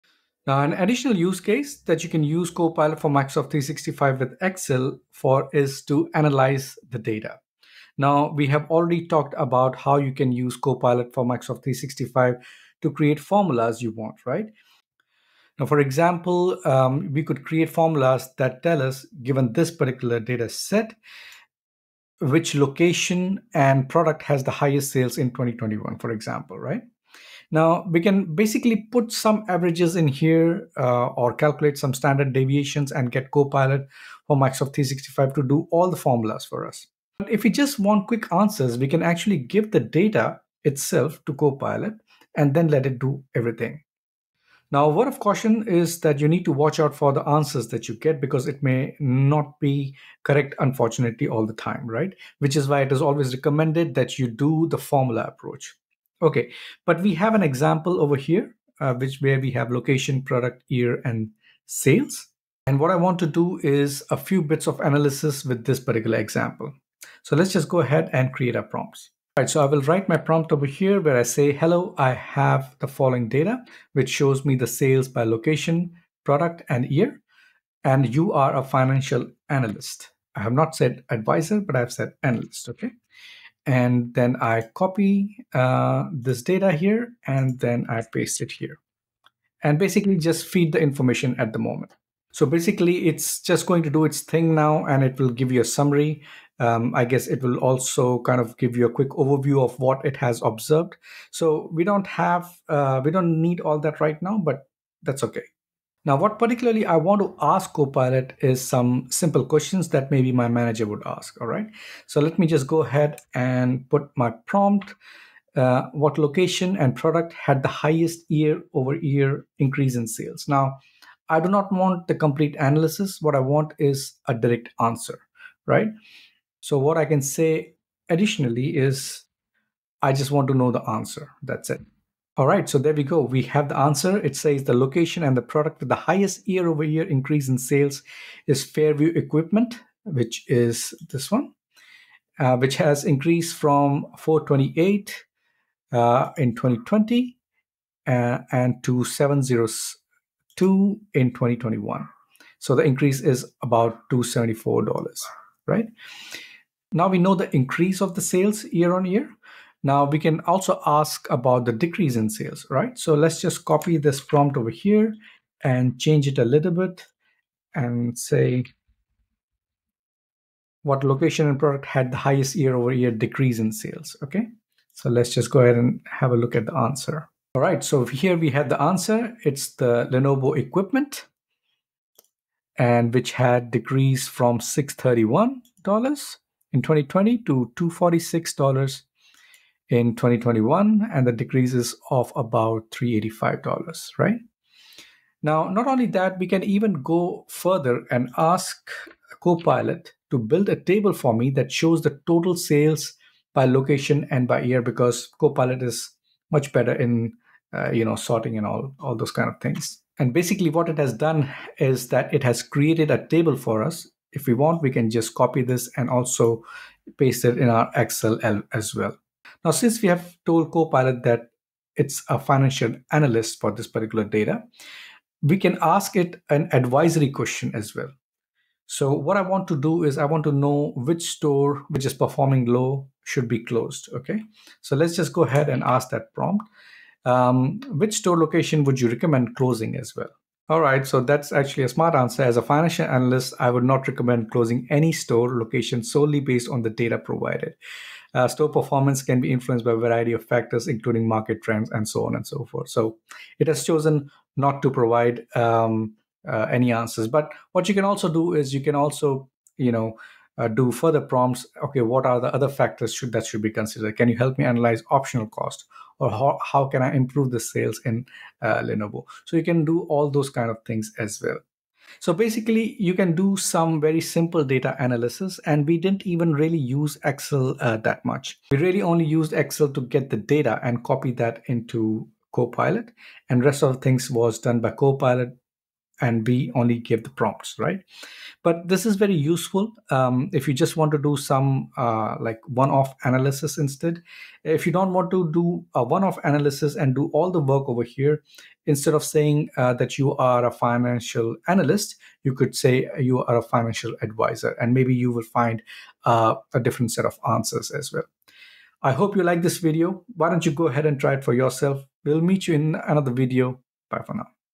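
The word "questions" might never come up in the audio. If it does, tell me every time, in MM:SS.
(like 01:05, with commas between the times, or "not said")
01:49, 03:47.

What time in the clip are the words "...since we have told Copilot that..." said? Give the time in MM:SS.
03:39.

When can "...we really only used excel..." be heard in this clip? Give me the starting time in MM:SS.
04:38.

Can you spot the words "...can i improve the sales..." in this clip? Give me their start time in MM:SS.
04:26.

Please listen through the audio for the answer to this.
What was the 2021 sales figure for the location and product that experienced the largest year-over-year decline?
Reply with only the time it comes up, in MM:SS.
03:07.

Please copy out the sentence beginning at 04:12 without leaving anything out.
So it has chosen not to provide um, uh, any answers.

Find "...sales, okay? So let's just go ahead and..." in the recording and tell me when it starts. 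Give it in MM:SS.
02:53.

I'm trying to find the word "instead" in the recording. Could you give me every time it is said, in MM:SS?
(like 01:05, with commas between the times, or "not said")
04:53, 04:58.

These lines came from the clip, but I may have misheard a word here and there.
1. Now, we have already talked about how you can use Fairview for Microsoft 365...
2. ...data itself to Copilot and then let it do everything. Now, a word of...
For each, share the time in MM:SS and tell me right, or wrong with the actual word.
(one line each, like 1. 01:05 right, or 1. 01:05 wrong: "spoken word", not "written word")
1. 00:07 wrong: "Copilot", not "Fairview"
2. 00:39 right.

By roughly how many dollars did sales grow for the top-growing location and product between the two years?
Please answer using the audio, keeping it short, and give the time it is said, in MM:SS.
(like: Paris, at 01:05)
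$274, at 02:34.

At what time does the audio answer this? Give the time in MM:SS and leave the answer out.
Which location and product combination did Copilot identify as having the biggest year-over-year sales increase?
02:18.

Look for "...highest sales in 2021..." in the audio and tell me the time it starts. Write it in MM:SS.
00:24.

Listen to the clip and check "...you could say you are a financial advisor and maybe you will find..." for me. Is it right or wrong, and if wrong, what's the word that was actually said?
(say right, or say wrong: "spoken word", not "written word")
right.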